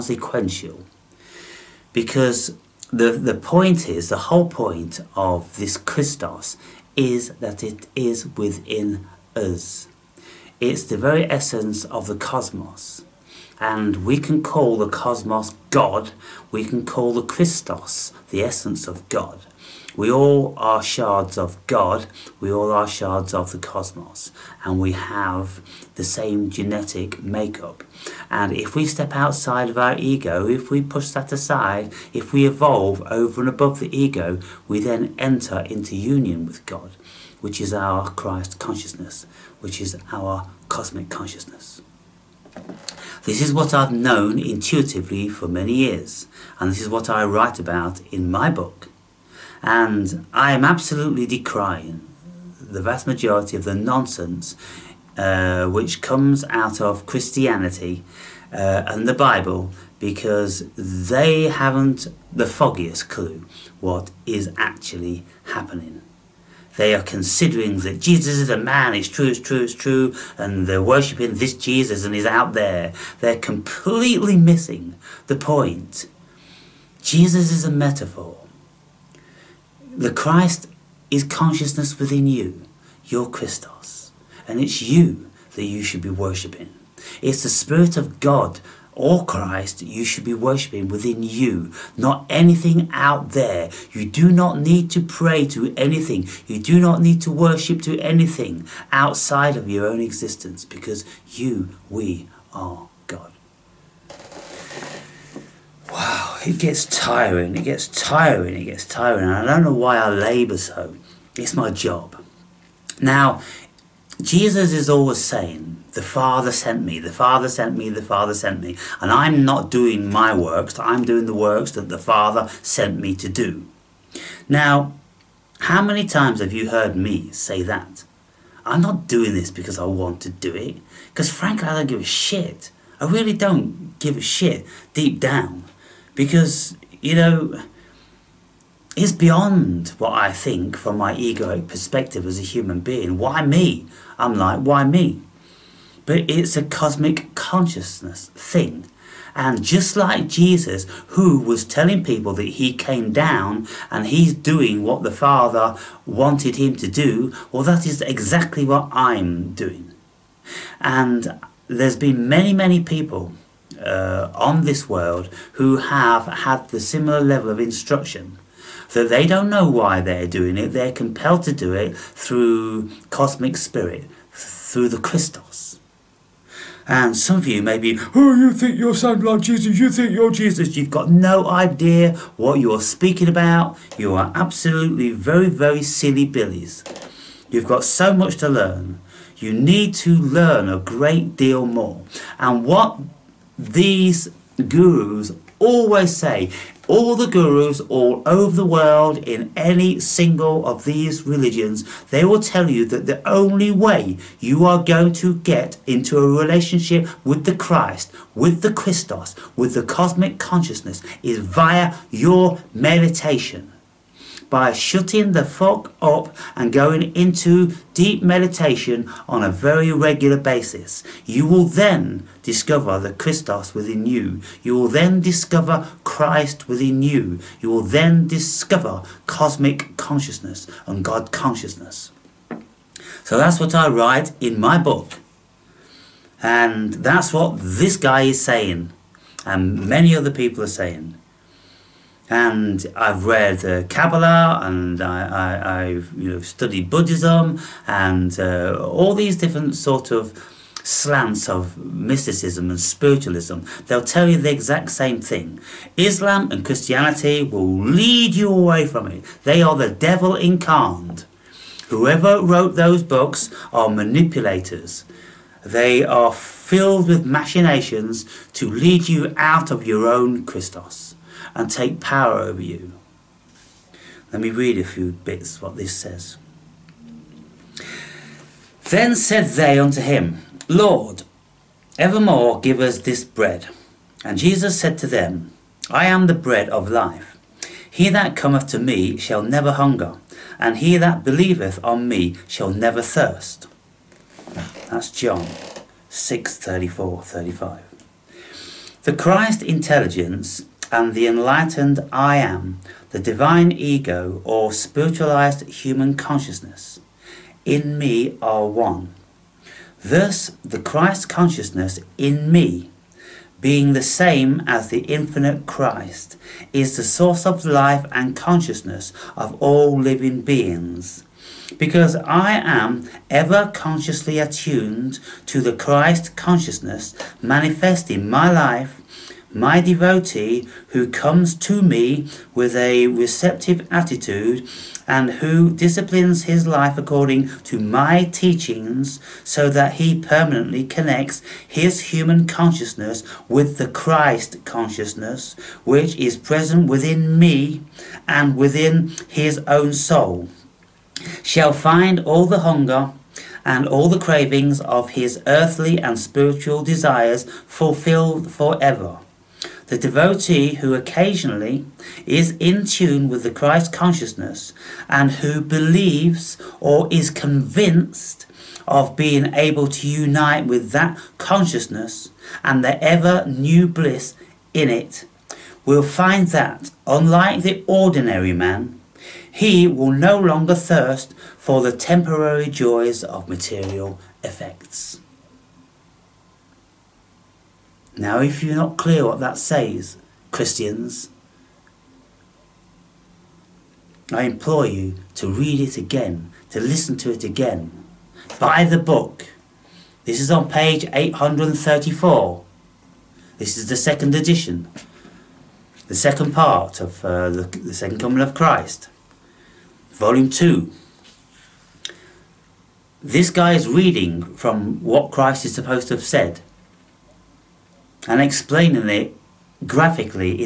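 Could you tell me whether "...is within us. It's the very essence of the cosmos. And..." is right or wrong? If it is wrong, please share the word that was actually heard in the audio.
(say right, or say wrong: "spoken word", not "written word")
right.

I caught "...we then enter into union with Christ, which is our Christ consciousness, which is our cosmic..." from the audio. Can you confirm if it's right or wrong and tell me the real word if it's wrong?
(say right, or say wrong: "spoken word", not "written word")
wrong: "God", not "Christ".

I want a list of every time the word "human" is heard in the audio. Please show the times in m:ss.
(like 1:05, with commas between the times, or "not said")
2:22, 5:05, 5:42.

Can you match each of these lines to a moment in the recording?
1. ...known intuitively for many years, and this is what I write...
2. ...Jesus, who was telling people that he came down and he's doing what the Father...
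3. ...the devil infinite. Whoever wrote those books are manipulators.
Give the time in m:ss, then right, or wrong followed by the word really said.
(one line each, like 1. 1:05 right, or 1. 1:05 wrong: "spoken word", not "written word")
1. 0:43 right
2. 2:30 right
3. 4:19 wrong: "incarnate", not "infinite".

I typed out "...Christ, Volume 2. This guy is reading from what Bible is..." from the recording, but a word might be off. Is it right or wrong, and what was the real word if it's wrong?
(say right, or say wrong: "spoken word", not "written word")
wrong: "Christ", not "Bible".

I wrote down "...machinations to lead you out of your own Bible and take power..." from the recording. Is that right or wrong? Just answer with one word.
wrong.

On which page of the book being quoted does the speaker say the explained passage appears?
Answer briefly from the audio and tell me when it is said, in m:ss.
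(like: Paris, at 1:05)
834, at 6:41.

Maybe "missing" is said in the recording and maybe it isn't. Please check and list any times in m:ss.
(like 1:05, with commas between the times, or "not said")
1:14.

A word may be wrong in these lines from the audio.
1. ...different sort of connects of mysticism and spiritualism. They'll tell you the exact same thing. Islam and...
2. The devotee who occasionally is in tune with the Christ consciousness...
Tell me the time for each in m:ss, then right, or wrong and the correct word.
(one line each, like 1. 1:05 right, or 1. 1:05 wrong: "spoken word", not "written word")
1. 4:09 wrong: "slants", not "connects"
2. 5:59 right.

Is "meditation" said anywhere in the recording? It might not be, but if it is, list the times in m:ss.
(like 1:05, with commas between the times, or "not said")
3:32, 3:38.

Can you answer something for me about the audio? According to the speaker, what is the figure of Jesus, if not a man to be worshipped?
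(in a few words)
A metaphor.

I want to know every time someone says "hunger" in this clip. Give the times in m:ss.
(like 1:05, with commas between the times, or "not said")
4:49, 5:52.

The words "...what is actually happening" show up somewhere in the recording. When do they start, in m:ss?
1:03.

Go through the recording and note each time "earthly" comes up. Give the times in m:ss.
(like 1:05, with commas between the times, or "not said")
5:55.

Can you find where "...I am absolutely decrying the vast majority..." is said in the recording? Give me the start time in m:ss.
0:50.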